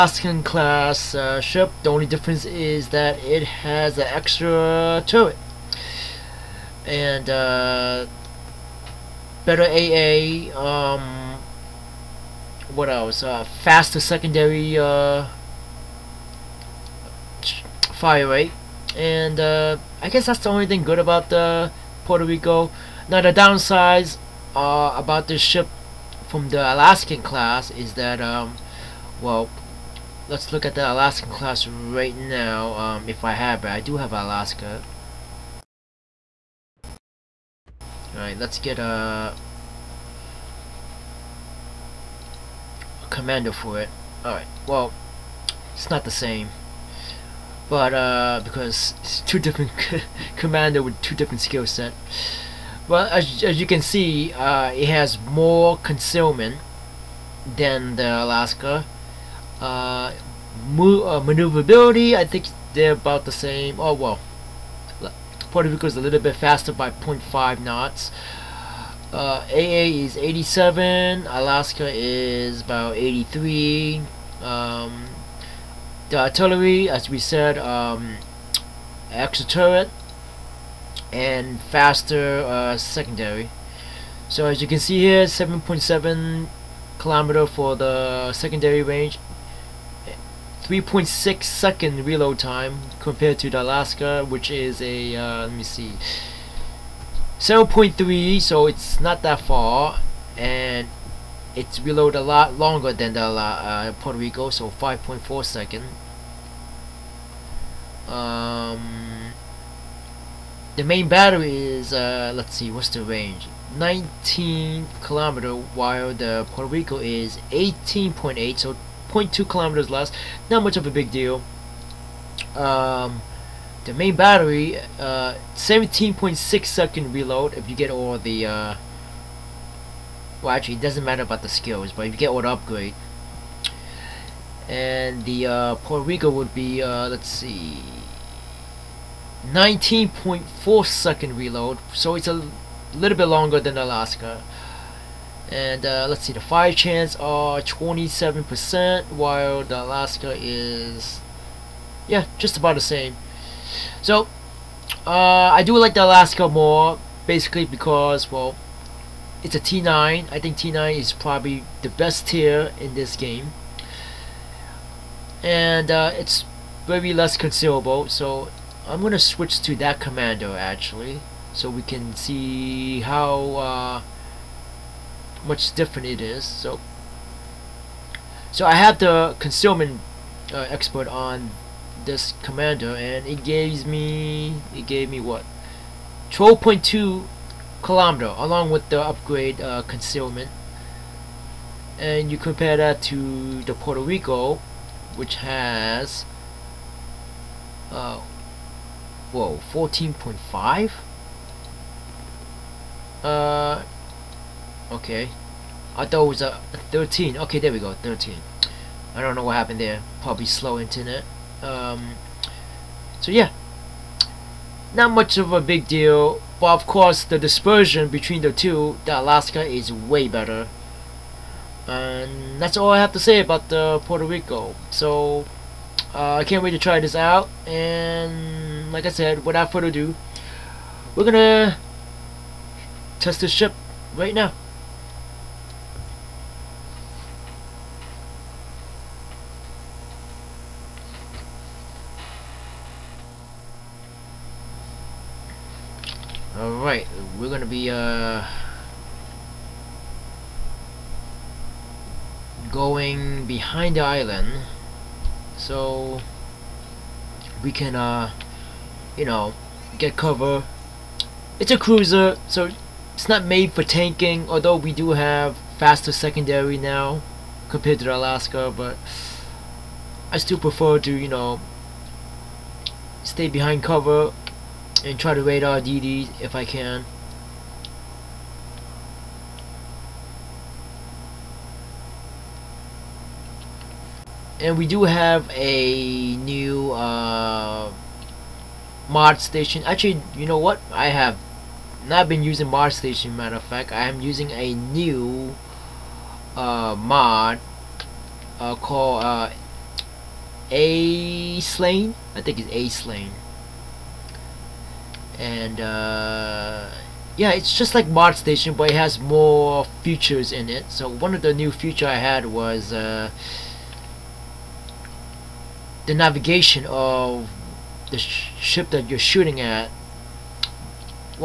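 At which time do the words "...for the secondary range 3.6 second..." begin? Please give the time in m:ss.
1:27.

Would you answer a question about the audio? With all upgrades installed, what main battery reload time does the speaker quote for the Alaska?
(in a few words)
17.6 seconds.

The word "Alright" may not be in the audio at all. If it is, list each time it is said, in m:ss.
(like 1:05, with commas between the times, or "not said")
0:38, 0:44.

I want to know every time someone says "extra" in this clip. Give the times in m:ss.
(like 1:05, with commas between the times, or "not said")
0:04, 1:19.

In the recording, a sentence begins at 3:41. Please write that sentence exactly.
And that's all I have to say about the uh, Puerto Rico.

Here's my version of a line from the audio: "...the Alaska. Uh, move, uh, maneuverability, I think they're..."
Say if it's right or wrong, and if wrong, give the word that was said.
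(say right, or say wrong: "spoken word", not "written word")
right.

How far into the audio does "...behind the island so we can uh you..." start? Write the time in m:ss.
4:13.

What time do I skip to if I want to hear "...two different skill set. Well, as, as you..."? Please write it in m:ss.
0:51.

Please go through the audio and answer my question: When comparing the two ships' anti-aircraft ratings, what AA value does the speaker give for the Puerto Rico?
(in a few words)
87.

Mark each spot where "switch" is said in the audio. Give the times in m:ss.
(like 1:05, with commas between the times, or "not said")
2:49.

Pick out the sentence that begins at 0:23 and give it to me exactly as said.
Now the downsides about this ship from the Alaskan class is that.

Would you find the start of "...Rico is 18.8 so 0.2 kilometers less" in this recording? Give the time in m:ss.
1:56.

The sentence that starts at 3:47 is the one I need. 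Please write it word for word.
And like I said, without further ado, we're gonna test this ship right now.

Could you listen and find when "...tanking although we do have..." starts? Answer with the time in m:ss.
4:23.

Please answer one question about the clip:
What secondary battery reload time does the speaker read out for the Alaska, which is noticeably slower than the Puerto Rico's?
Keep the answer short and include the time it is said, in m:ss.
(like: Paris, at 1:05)
5.4 seconds, at 1:44.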